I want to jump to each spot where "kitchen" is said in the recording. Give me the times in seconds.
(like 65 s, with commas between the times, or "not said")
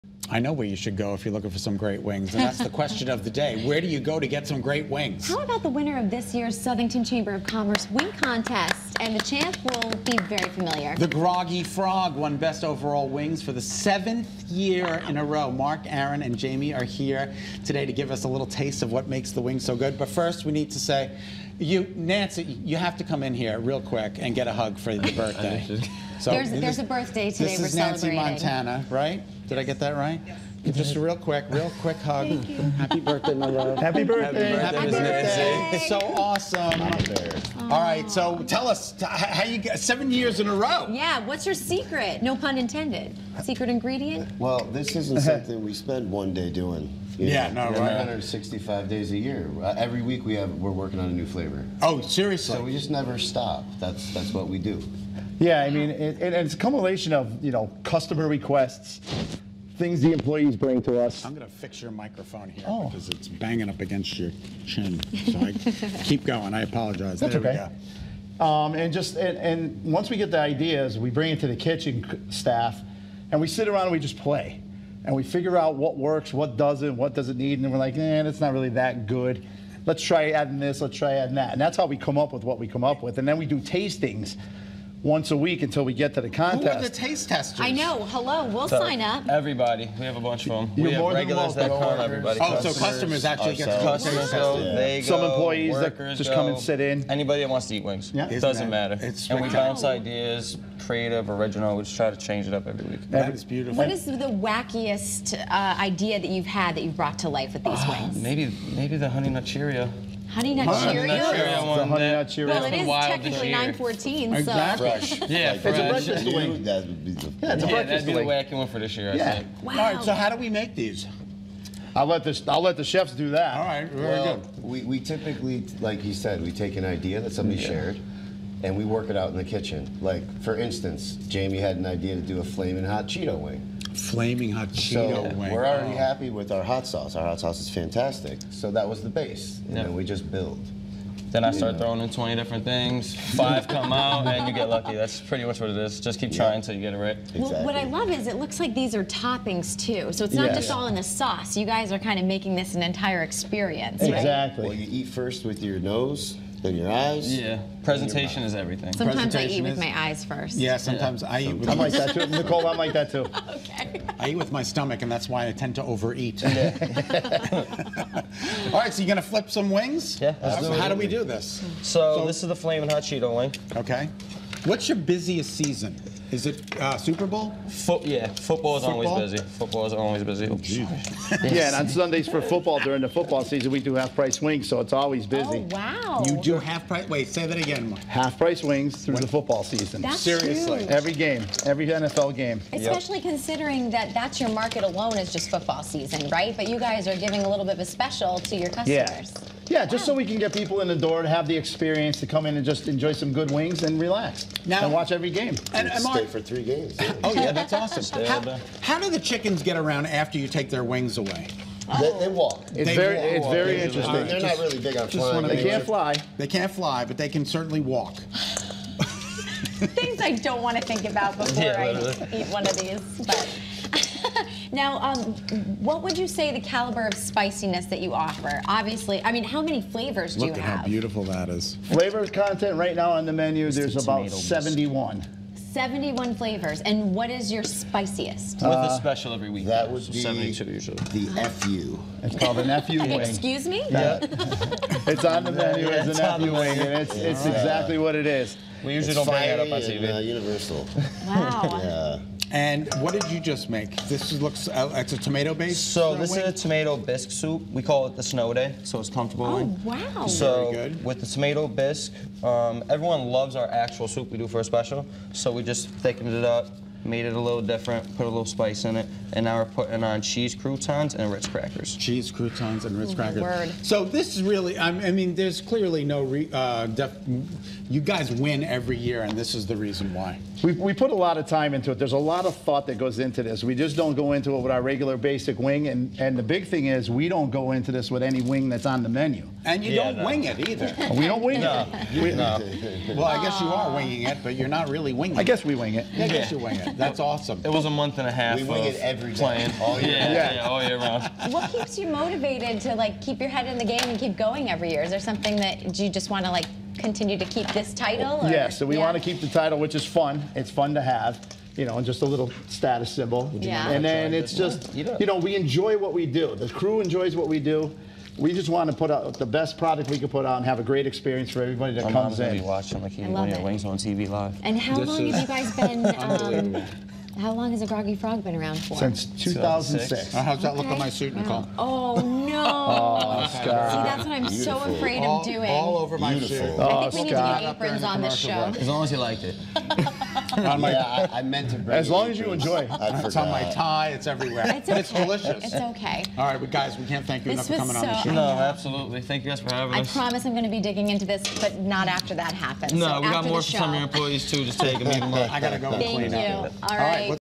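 71 s, 129 s.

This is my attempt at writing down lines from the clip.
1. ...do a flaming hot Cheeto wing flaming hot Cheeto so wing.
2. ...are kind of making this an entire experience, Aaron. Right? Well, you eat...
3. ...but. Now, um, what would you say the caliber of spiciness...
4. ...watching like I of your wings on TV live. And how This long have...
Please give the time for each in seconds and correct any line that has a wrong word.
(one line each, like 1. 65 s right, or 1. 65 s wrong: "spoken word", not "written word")
1. 132 s right
2. 151 s wrong: "Exactly", not "Aaron"
3. 223 s right
4. 322 s right.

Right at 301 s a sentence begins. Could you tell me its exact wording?
What keeps you motivated to like keep your head in the game and keep going every year?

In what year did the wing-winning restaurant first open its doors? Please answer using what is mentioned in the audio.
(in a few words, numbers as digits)
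2006.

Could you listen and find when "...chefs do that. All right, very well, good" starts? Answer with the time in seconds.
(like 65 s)
122 s.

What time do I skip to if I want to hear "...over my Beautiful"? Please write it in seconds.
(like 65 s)
335 s.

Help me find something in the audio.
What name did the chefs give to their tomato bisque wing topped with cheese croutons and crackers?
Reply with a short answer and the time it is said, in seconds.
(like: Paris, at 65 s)
Snow day, at 258 s.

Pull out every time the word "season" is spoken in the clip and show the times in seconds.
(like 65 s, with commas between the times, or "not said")
175 s, 183 s, 189 s, 195 s.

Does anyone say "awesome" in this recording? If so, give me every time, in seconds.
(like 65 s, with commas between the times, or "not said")
35 s, 207 s, 297 s.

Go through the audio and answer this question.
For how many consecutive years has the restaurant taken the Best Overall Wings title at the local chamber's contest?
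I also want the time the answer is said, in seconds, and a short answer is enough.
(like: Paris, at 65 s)
7, at 13 s.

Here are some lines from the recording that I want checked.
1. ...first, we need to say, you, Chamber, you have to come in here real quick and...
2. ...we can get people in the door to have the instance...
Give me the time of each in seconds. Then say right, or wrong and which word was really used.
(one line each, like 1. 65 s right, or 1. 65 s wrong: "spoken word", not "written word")
1. 20 s wrong: "Nancy", not "Chamber"
2. 200 s wrong: "experience", not "instance".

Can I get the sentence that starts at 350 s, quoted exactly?
I promise I'm going to be digging into this, but not after that happens.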